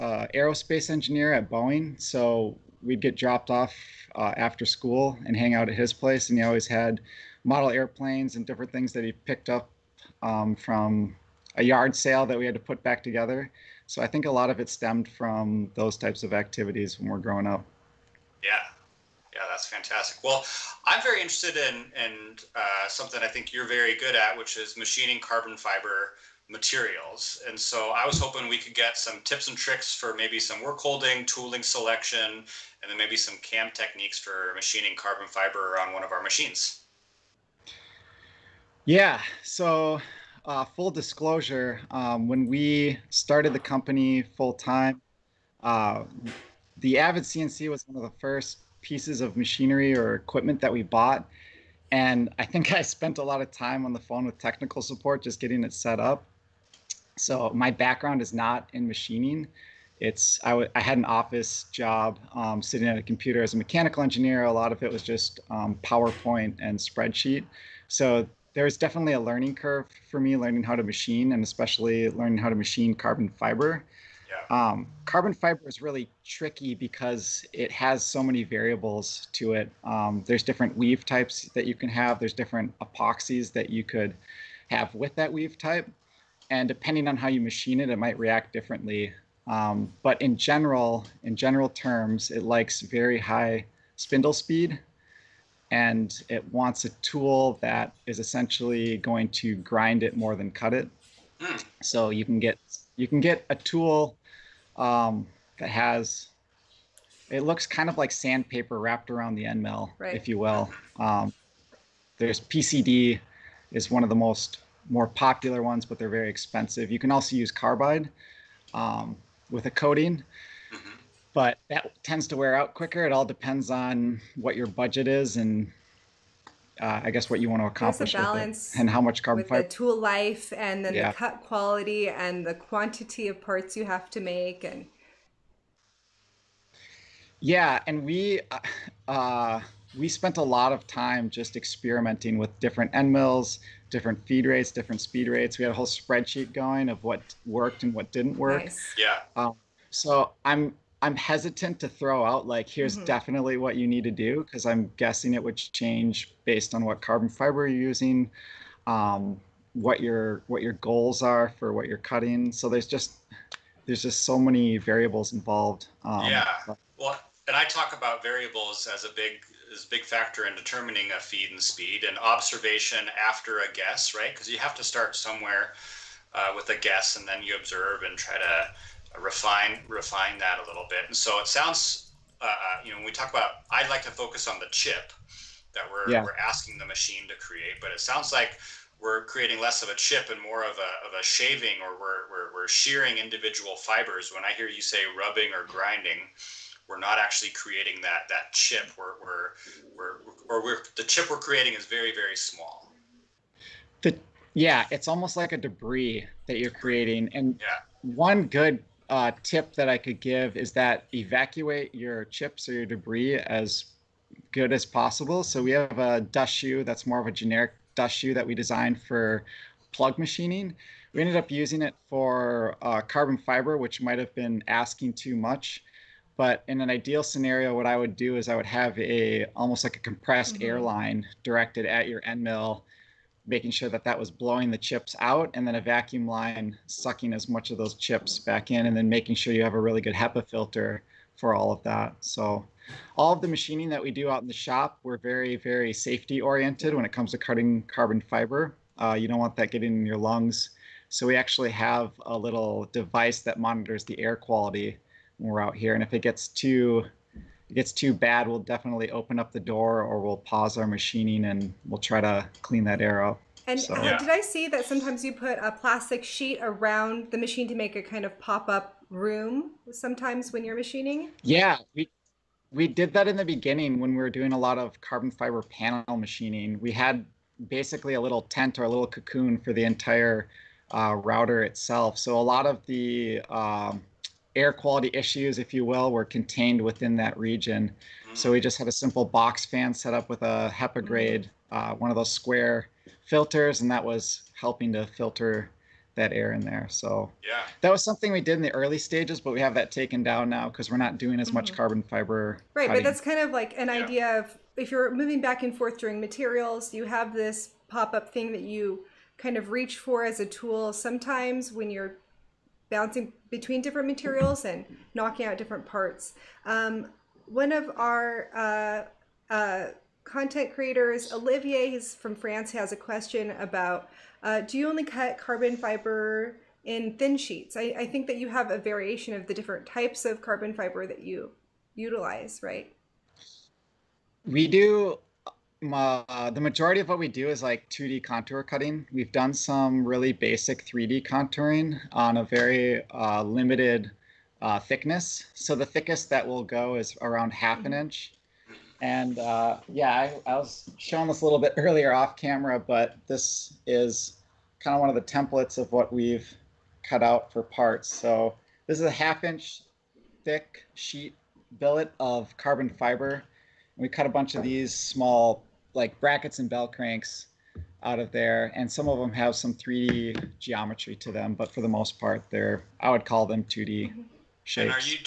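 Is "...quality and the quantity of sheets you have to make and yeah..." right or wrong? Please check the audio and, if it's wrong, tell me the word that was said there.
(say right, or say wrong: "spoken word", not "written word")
wrong: "parts", not "sheets".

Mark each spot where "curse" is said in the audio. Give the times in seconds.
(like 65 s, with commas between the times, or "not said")
not said.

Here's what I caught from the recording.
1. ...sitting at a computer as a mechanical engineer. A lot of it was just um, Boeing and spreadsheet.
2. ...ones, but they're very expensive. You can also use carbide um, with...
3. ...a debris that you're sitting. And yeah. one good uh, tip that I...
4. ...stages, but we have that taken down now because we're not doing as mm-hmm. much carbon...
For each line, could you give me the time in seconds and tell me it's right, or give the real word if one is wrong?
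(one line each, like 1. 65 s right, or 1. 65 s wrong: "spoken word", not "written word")
1. 62 s wrong: "PowerPoint", not "Boeing"
2. 115 s right
3. 205 s wrong: "creating", not "sitting"
4. 298 s right.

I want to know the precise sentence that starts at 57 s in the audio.
So my background is not in machining.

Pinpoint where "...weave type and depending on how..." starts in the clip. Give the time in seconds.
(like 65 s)
85 s.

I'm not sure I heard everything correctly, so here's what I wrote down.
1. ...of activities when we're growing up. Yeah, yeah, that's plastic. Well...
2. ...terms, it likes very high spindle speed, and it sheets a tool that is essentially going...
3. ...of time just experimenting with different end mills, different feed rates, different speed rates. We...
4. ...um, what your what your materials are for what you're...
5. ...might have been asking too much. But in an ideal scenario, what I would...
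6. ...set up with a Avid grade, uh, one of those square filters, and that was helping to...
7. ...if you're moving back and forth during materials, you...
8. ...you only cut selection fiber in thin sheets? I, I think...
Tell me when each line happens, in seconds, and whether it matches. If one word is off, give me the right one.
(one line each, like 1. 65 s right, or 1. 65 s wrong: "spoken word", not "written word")
1. 16 s wrong: "fantastic", not "plastic"
2. 91 s wrong: "wants", not "sheets"
3. 140 s right
4. 158 s wrong: "goals", not "materials"
5. 224 s right
6. 289 s wrong: "HEPA", not "Avid"
7. 304 s right
8. 324 s wrong: "carbon", not "selection".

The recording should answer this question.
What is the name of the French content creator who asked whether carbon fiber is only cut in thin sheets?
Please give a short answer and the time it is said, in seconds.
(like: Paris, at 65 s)
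Olivier, at 321 s.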